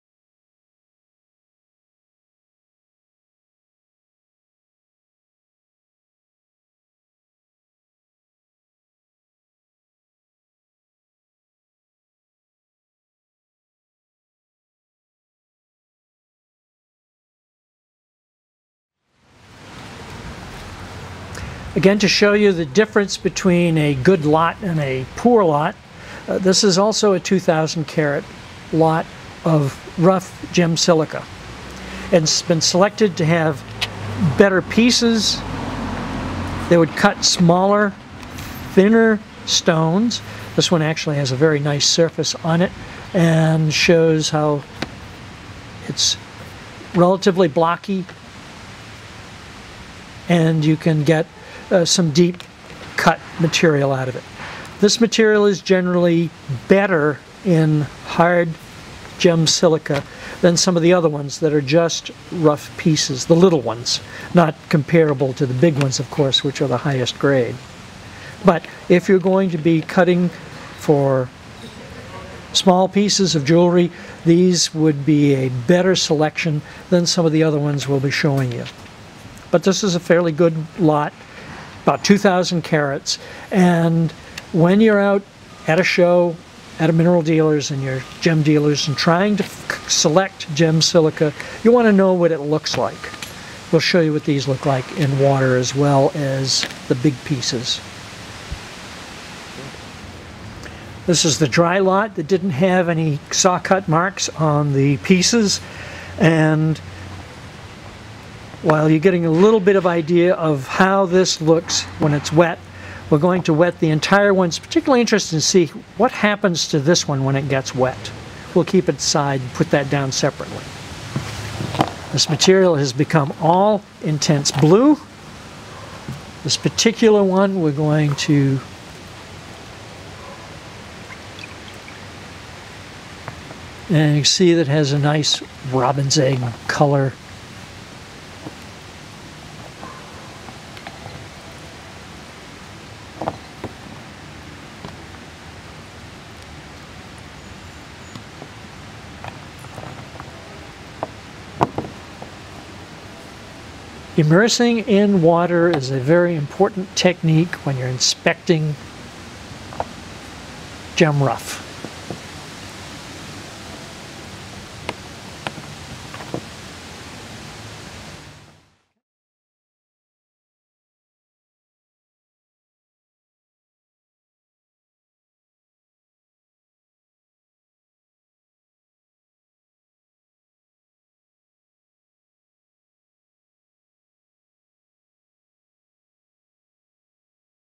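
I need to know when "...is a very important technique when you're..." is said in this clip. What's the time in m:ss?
2:35.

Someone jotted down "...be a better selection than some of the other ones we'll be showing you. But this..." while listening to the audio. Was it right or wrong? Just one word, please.
right.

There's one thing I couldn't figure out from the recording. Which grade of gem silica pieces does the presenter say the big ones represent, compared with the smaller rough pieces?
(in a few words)
highest grade.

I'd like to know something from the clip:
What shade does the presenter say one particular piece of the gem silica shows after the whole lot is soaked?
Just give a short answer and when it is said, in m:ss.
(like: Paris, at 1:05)
robin's egg, at 2:15.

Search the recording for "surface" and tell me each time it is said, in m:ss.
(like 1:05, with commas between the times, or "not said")
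0:41.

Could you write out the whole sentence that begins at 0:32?
And it's been selected to have better pieces.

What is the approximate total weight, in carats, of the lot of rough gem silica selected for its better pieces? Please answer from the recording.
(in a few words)
2,000 carats.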